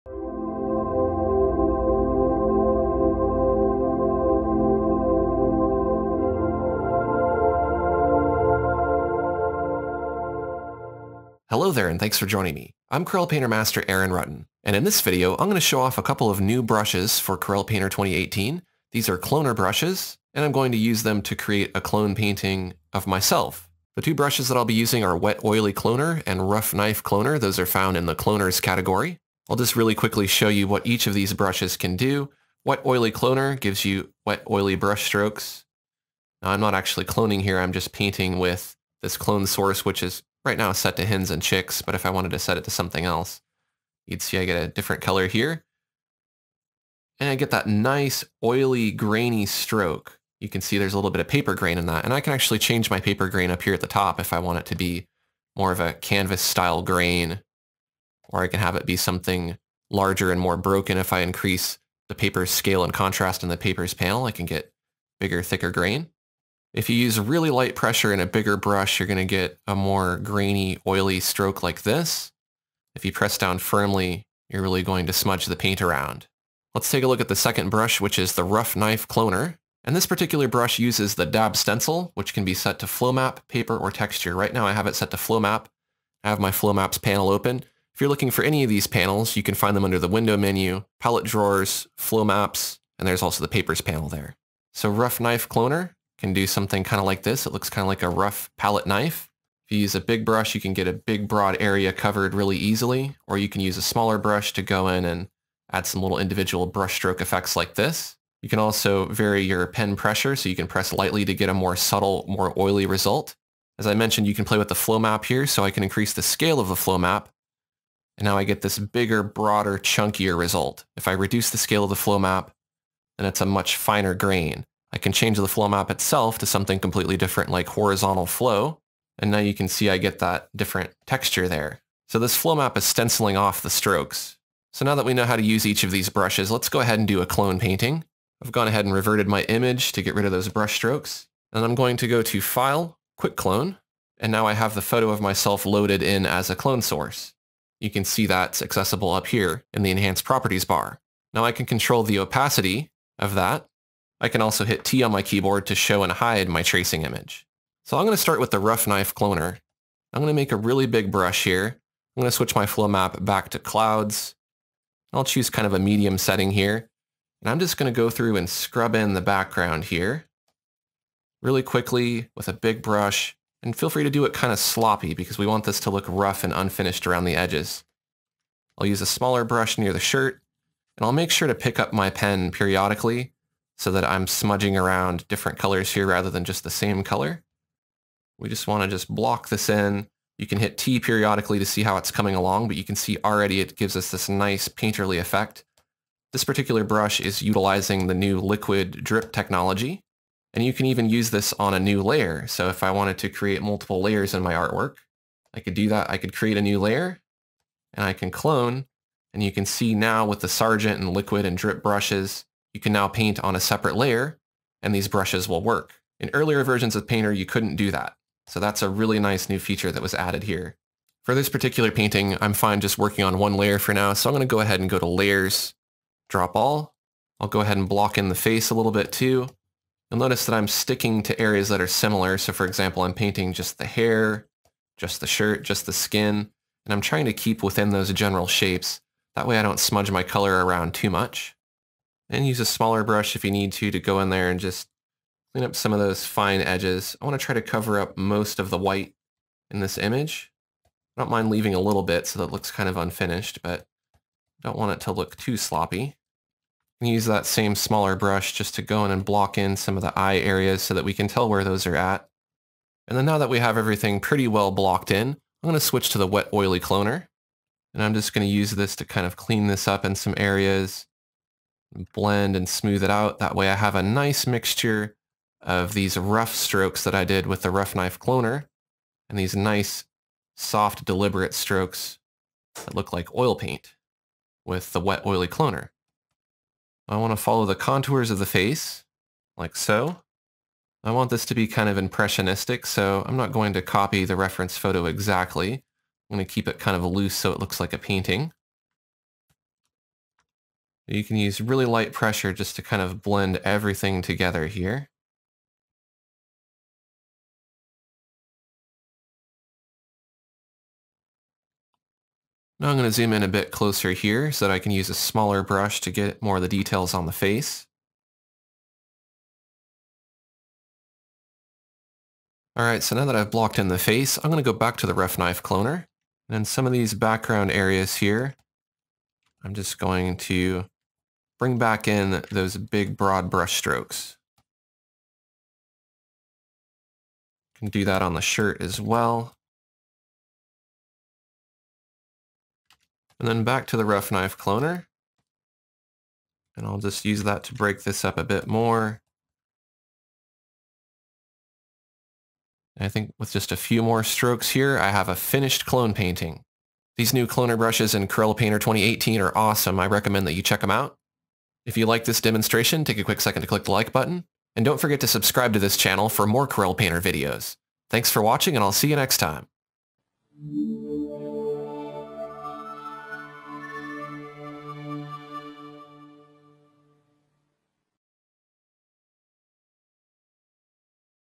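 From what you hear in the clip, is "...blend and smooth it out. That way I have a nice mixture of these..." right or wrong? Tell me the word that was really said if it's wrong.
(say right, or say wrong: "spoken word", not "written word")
right.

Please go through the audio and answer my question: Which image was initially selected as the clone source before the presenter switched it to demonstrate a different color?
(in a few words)
hens and chicks.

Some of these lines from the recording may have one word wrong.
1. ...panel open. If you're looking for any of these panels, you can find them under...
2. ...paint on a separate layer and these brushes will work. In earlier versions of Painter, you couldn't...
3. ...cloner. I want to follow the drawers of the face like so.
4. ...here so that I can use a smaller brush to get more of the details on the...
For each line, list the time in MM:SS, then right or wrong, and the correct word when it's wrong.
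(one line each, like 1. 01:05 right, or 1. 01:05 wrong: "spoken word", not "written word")
1. 01:26 right
2. 03:33 right
3. 04:45 wrong: "contours", not "drawers"
4. 05:14 right.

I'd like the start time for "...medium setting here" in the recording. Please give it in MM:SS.
02:45.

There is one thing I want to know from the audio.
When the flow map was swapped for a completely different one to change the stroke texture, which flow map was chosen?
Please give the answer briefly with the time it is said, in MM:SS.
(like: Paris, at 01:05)
horizontal flow, at 02:07.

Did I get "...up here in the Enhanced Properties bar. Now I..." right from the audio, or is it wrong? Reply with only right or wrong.
right.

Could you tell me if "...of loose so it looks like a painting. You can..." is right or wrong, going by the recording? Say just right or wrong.
right.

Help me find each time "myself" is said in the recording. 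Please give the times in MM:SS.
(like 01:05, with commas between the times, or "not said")
00:23, 02:25.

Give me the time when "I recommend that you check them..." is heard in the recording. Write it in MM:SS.
05:59.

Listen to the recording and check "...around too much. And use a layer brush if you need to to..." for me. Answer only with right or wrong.
wrong.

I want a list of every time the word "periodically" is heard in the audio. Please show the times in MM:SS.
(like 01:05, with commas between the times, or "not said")
03:02, 03:10.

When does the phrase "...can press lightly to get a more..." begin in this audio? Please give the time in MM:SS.
01:50.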